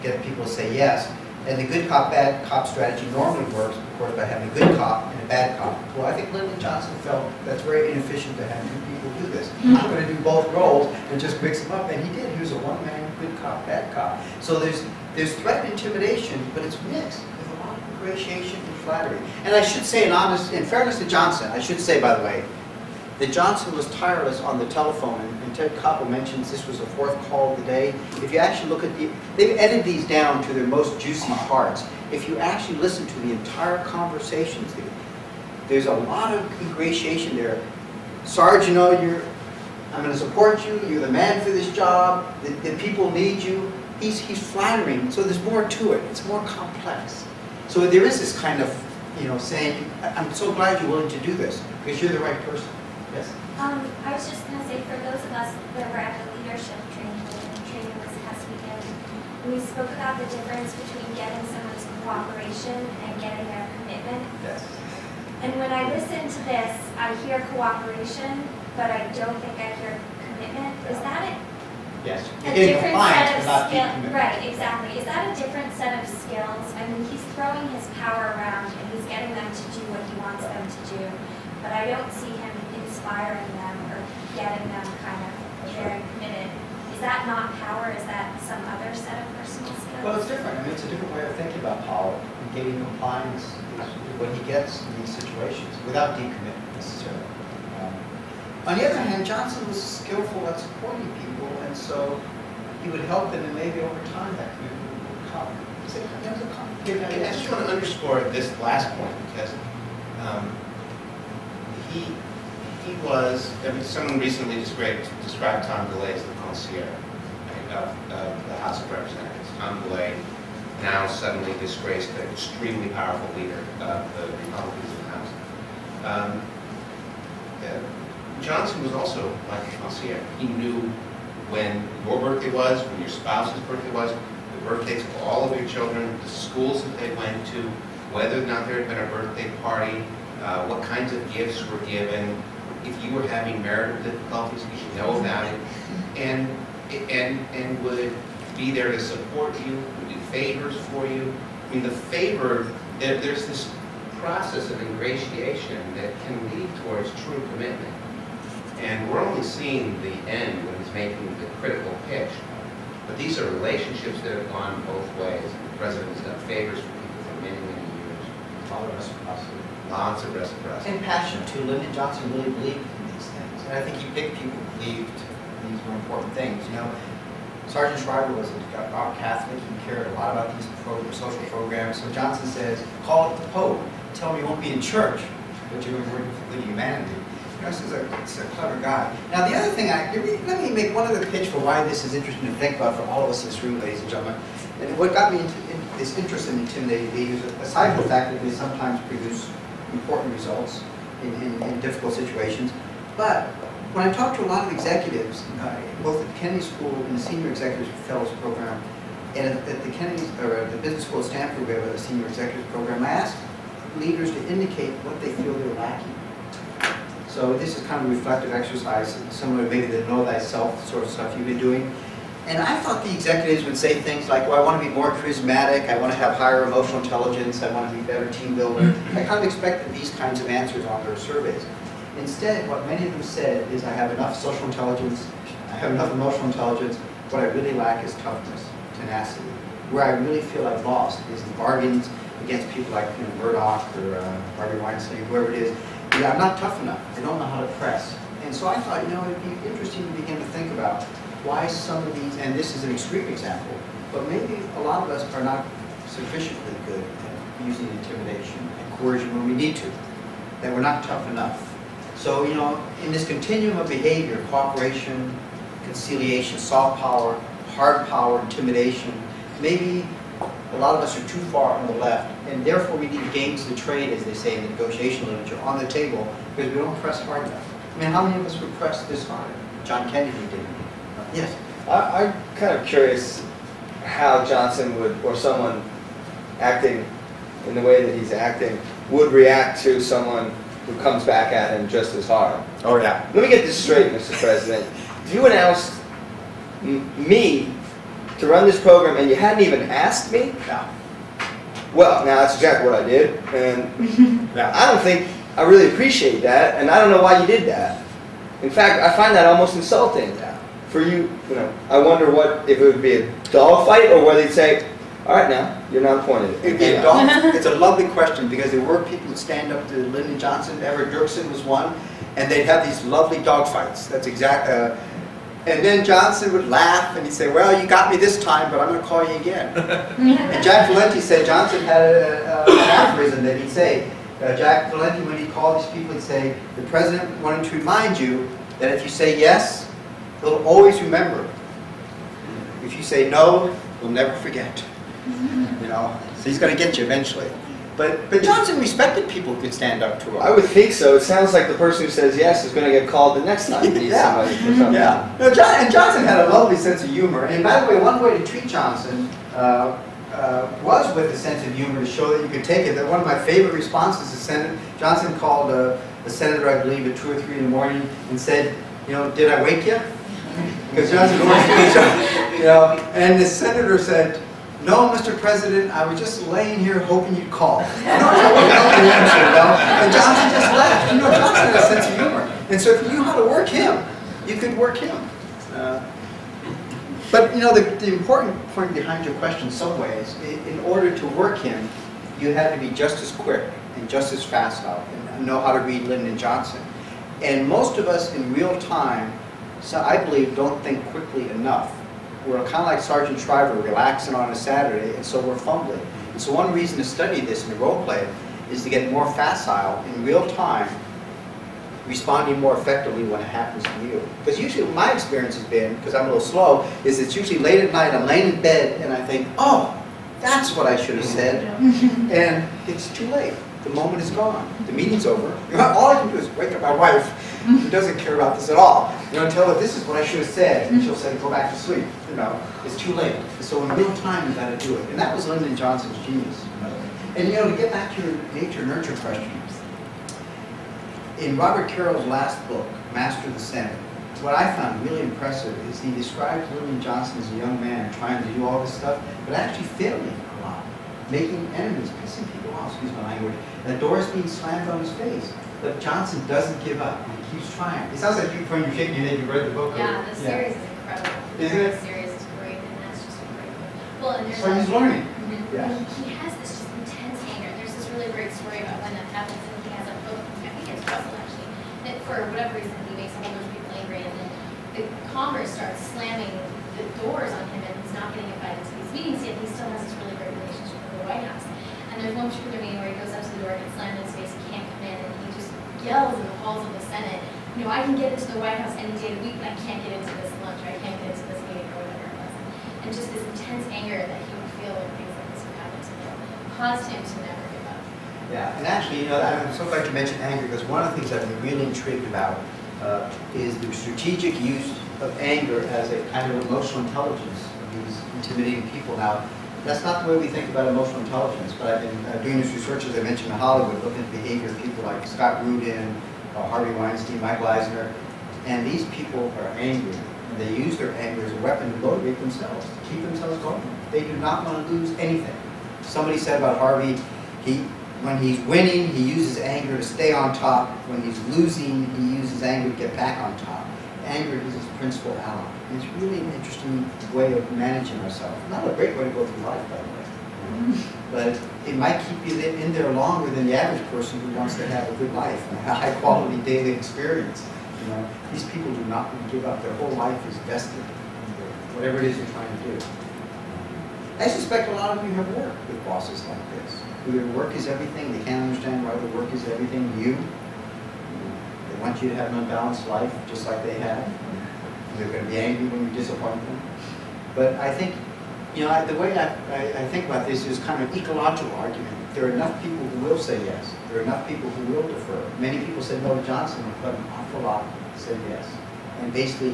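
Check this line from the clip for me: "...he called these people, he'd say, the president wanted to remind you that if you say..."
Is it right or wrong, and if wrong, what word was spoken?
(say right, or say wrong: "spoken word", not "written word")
right.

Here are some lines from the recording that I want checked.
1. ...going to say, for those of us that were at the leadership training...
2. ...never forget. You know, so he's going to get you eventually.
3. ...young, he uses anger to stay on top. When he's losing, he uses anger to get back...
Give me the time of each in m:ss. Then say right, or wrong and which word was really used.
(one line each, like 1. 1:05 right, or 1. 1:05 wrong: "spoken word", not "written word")
1. 0:54 right
2. 5:44 right
3. 8:48 wrong: "winning", not "young".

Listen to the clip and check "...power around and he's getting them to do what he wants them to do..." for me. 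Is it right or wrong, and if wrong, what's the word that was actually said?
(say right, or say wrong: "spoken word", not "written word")
right.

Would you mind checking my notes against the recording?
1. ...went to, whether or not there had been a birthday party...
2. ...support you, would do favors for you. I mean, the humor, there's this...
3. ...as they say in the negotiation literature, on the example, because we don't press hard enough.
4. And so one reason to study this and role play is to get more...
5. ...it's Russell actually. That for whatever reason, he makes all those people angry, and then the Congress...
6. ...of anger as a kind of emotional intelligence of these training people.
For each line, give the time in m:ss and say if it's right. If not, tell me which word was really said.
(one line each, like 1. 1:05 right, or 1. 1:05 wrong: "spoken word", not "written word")
1. 2:17 right
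2. 2:28 wrong: "favor", not "humor"
3. 4:34 wrong: "table", not "example"
4. 6:46 right
5. 7:50 right
6. 8:25 wrong: "intimidating", not "training".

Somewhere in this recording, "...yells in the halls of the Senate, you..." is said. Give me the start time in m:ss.
8:06.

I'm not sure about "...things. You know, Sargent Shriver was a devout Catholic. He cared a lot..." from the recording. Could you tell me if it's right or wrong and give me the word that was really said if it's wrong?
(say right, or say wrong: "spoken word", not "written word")
right.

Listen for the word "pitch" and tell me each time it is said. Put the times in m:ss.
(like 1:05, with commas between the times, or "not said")
2:42, 3:11.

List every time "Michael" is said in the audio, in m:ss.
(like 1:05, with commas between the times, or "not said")
8:37.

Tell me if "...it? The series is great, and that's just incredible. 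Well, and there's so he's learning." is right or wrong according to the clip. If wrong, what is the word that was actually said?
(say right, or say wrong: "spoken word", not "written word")
right.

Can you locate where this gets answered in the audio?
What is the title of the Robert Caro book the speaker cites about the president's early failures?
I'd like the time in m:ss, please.
7:23.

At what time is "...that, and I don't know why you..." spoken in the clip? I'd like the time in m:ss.
5:06.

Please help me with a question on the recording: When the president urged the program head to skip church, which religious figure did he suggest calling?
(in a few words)
the Pope.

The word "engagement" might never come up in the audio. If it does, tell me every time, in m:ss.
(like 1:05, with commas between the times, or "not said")
not said.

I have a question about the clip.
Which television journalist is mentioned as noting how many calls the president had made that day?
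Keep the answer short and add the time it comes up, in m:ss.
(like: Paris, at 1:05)
Ted Koppel, at 0:25.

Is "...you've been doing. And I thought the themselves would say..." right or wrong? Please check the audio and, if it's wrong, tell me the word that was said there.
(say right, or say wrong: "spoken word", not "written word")
wrong: "executives", not "themselves".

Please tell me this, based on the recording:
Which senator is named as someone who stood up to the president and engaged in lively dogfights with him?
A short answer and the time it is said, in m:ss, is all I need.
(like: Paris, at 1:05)
Everett Dirksen, at 5:20.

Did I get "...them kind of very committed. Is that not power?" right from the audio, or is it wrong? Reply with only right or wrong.
right.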